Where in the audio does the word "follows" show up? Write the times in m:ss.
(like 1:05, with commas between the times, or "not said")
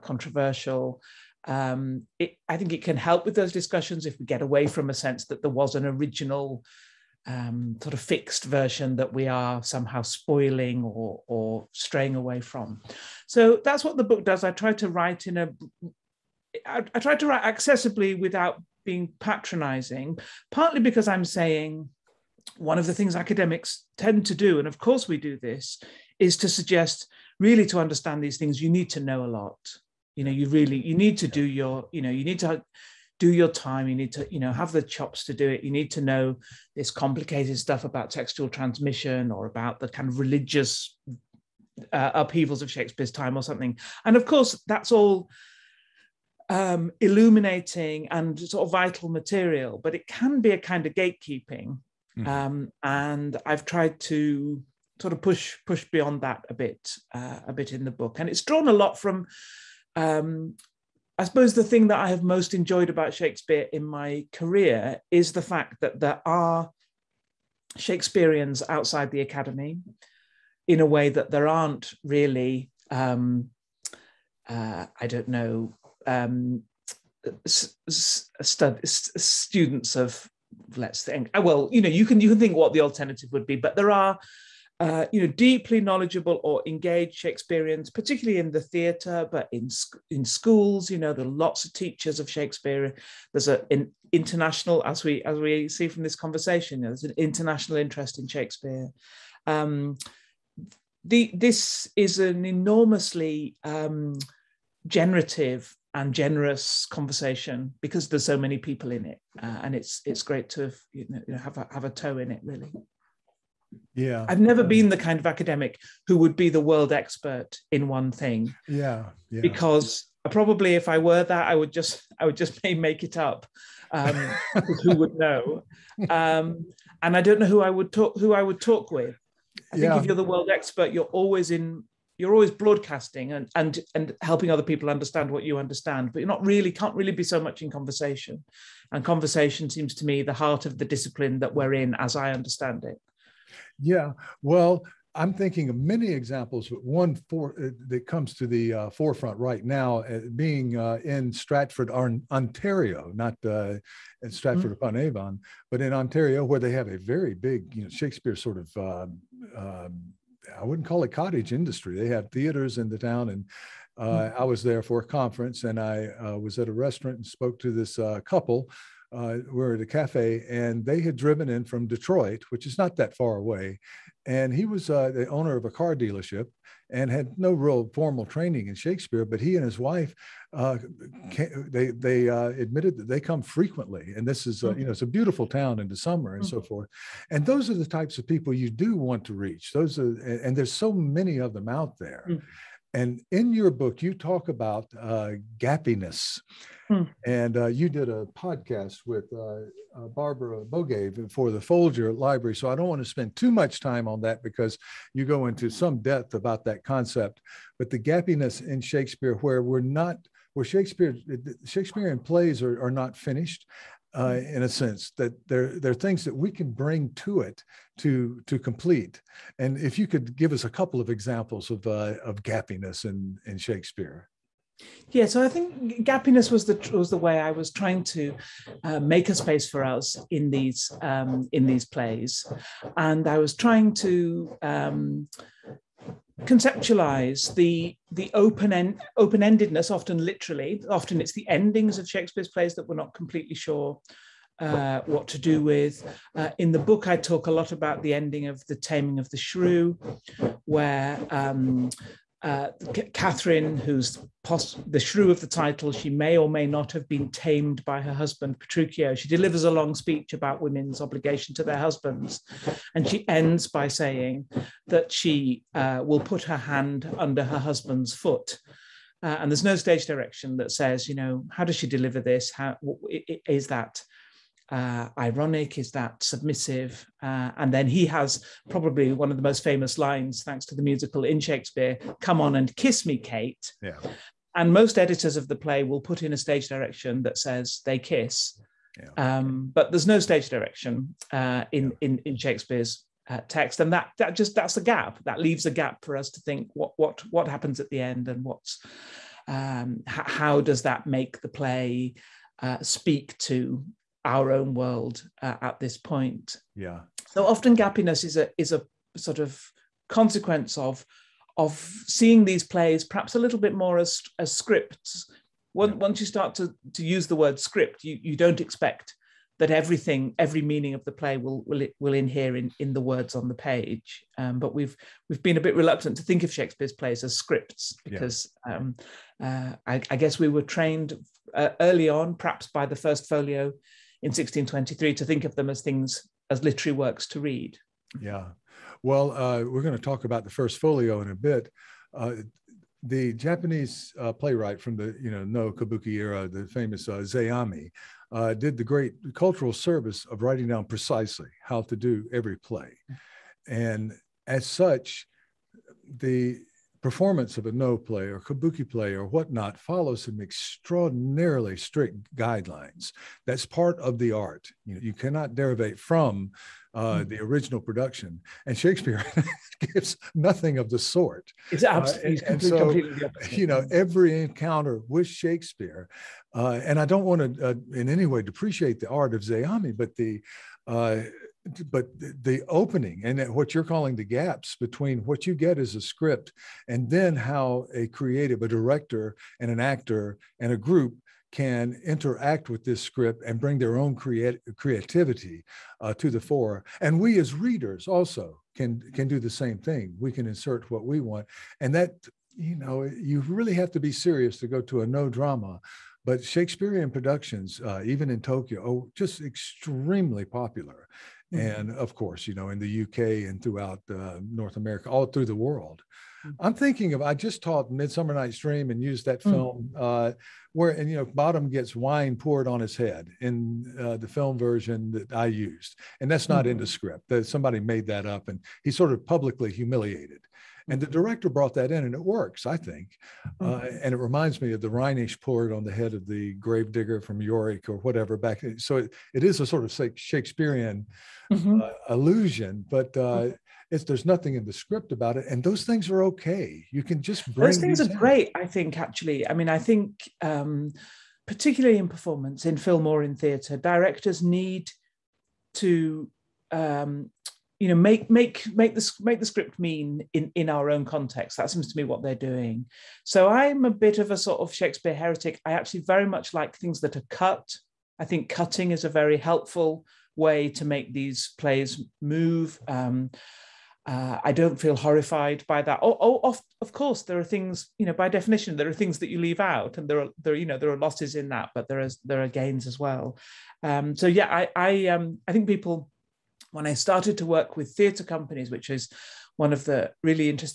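5:59.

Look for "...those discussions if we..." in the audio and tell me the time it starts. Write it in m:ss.
0:03.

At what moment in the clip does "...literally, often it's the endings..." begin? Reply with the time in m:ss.
4:00.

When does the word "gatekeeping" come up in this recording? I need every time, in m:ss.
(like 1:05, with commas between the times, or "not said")
0:50.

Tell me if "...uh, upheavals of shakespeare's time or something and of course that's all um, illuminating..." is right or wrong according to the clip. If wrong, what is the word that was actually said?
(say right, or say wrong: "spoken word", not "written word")
right.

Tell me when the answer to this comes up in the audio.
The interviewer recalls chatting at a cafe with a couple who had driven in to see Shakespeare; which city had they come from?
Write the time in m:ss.
2:51.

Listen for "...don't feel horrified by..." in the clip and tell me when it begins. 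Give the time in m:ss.
7:54.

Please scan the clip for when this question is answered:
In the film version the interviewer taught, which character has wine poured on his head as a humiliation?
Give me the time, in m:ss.
7:01.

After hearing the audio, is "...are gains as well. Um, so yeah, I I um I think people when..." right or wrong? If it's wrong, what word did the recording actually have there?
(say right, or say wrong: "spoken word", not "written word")
right.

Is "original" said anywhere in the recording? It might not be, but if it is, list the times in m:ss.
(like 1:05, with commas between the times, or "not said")
0:05, 6:07.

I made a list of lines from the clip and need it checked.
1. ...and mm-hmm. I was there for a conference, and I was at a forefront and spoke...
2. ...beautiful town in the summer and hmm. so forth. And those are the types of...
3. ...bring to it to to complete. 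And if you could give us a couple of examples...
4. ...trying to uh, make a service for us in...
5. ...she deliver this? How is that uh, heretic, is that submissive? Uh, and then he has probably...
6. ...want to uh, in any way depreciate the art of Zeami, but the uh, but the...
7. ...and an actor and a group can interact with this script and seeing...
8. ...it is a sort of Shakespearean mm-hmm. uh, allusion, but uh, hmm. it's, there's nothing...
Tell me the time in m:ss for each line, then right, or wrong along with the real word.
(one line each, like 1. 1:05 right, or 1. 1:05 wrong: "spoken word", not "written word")
1. 2:43 wrong: "restaurant", not "forefront"
2. 3:05 right
3. 3:36 right
4. 3:47 wrong: "space", not "service"
5. 4:31 wrong: "ironic", not "heretic"
6. 6:17 right
7. 6:29 wrong: "bring", not "seeing"
8. 7:19 right.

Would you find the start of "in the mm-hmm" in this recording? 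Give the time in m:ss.
7:06.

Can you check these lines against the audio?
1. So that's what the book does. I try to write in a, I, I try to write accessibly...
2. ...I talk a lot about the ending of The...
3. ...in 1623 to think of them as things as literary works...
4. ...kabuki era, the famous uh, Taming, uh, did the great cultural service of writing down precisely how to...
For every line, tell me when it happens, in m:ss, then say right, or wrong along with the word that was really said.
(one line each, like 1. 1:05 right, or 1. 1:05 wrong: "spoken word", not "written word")
1. 0:13 right
2. 4:07 right
3. 5:34 right
4. 5:45 wrong: "Zeami", not "Taming".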